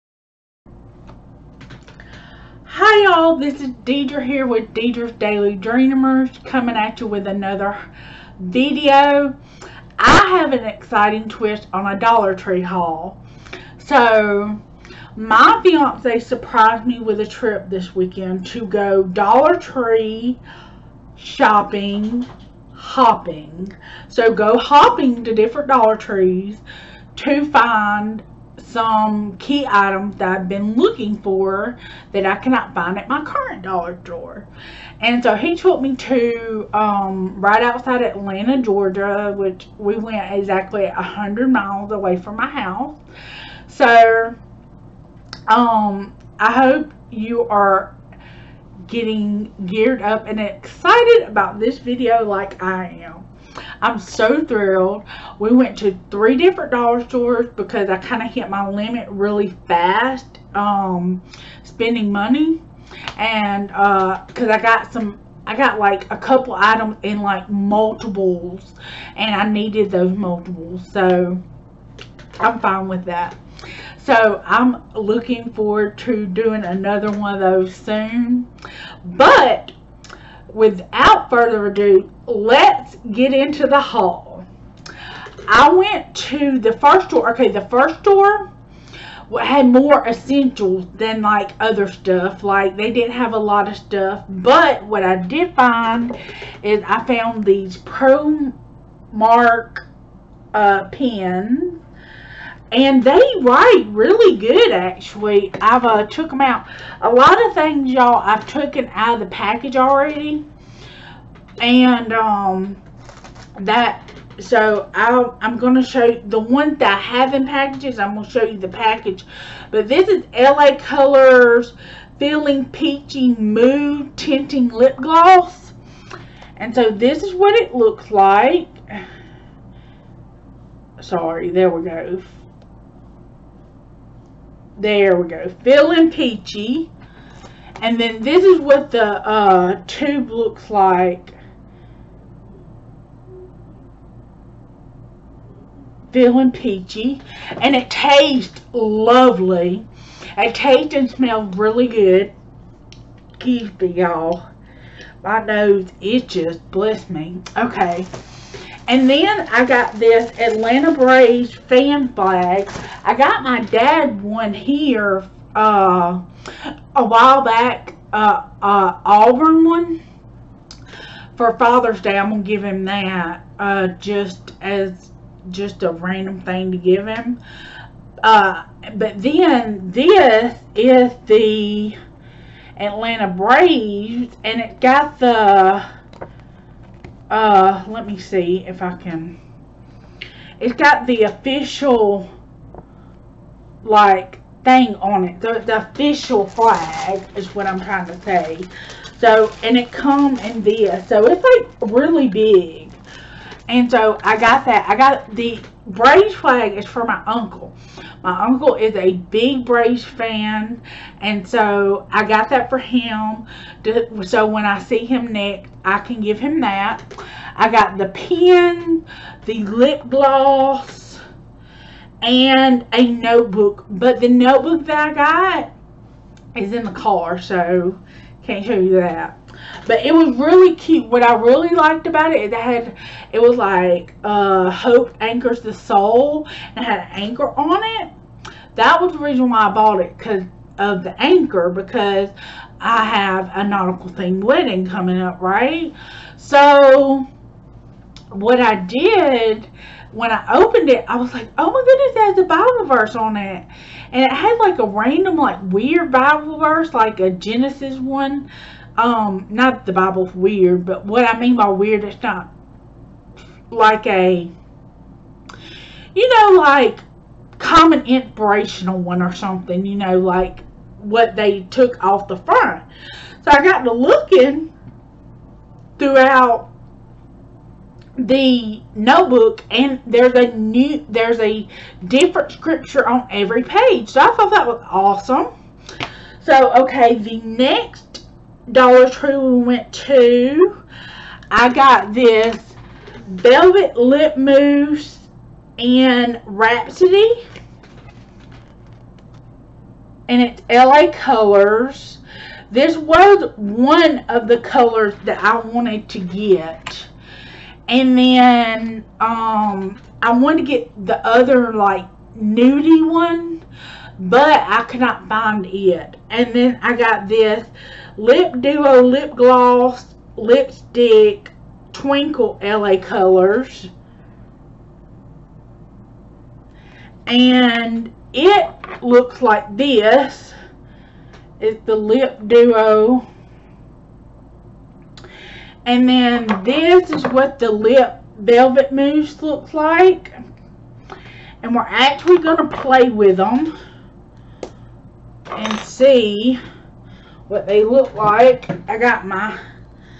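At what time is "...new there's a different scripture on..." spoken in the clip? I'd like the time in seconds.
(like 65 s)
280 s.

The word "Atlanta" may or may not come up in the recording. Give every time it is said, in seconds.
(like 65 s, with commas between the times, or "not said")
38 s, 160 s, 182 s.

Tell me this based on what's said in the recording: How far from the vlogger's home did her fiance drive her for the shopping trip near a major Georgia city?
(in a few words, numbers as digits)
100 miles.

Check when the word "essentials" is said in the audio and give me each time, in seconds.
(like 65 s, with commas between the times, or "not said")
90 s.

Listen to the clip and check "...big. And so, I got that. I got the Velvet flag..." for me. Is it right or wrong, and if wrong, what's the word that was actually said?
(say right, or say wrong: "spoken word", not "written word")
wrong: "Braves", not "Velvet".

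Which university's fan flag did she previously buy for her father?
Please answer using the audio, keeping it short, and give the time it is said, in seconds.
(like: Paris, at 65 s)
Auburn, at 169 s.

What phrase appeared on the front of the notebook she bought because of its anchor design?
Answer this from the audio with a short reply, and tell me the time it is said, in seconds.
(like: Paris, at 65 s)
Hope anchors the soul, at 234 s.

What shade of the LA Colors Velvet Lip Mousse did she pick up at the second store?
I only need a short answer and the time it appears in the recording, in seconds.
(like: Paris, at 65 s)
Rhapsody, at 296 s.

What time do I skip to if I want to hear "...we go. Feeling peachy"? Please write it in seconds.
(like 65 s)
135 s.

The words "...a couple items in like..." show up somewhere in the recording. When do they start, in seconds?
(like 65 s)
66 s.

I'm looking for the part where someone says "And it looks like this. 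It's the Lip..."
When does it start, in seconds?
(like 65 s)
327 s.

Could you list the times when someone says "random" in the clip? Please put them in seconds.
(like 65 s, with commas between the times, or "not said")
175 s, 254 s.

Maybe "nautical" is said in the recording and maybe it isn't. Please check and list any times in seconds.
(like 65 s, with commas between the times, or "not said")
243 s.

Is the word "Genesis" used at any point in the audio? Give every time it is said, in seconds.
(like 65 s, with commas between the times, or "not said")
257 s.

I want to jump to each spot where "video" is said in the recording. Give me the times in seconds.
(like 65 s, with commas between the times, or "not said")
8 s, 51 s.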